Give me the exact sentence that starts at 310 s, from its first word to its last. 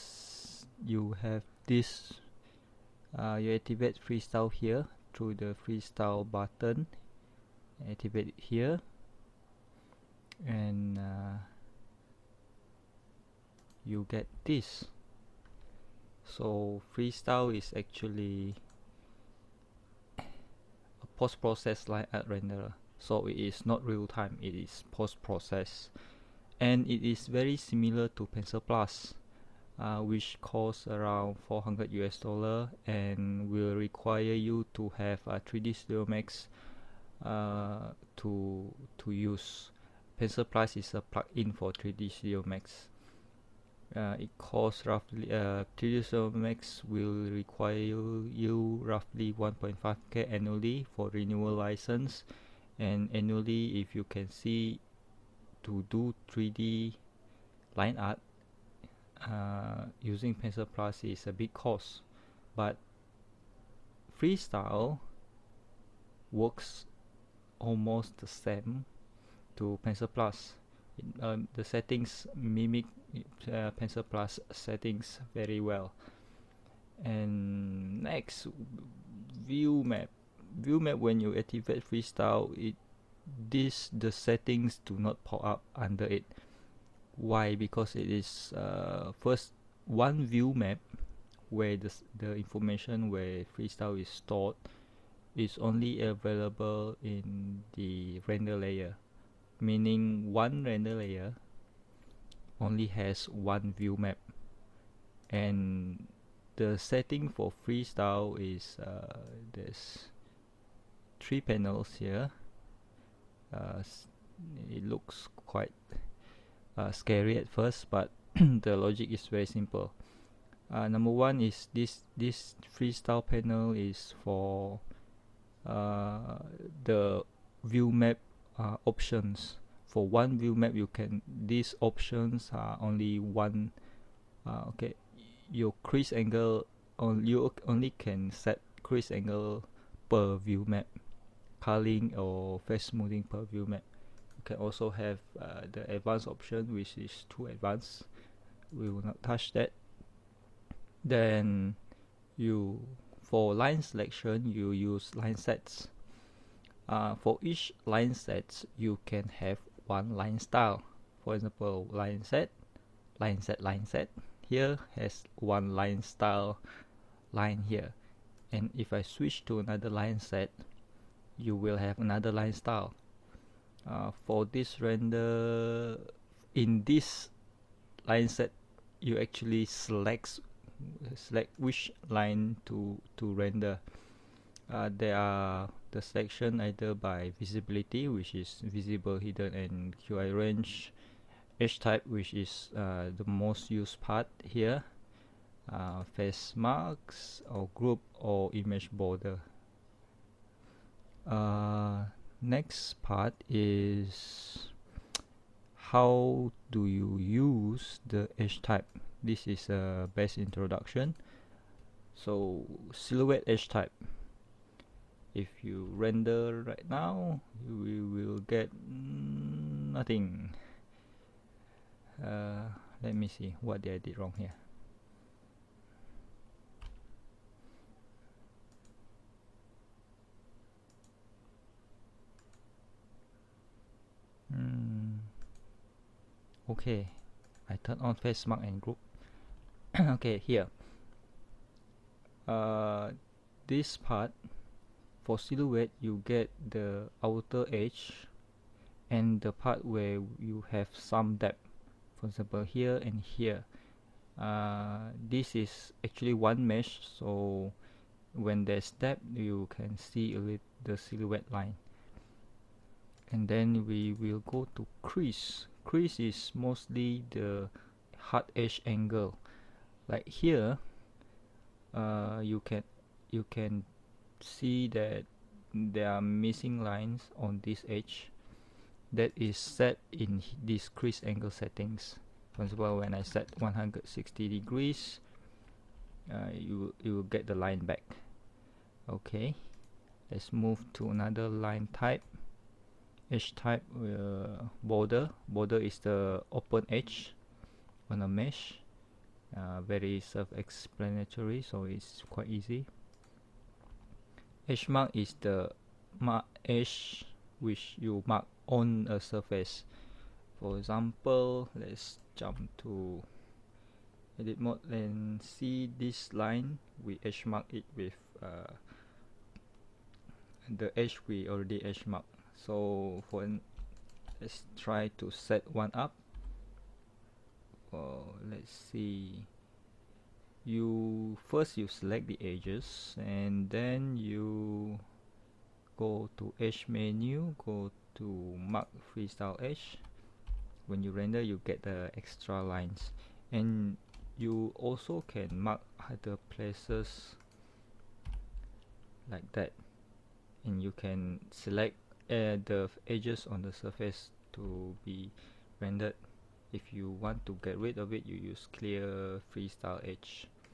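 For example, let's jump to edit mode and see this line.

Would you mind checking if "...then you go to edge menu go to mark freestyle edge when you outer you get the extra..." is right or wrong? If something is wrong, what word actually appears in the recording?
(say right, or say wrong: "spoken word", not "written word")
wrong: "render", not "outer".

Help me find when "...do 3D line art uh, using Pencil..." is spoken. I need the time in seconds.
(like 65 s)
55 s.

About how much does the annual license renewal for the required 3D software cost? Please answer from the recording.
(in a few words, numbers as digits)
1.5k.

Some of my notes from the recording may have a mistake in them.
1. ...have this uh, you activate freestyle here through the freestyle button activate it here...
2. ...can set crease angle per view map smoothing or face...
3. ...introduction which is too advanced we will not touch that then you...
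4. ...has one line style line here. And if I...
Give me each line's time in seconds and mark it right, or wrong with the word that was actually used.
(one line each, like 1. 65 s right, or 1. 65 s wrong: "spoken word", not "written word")
1. 1 s right
2. 137 s wrong: "curling", not "smoothing"
3. 146 s wrong: "option", not "introduction"
4. 164 s right.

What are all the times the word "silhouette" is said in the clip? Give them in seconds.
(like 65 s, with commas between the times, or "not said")
212 s, 245 s, 260 s.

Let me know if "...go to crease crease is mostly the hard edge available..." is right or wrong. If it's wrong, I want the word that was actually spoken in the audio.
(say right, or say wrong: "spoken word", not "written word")
wrong: "angle", not "available".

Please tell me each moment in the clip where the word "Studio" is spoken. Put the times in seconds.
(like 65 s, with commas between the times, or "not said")
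35 s, 42 s.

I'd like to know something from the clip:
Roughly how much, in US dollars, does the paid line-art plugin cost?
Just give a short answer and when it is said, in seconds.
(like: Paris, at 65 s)
400, at 31 s.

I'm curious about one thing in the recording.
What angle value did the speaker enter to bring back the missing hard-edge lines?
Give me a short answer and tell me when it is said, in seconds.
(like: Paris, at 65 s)
160 degrees, at 283 s.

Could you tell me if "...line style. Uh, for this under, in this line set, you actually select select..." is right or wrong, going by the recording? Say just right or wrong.
wrong.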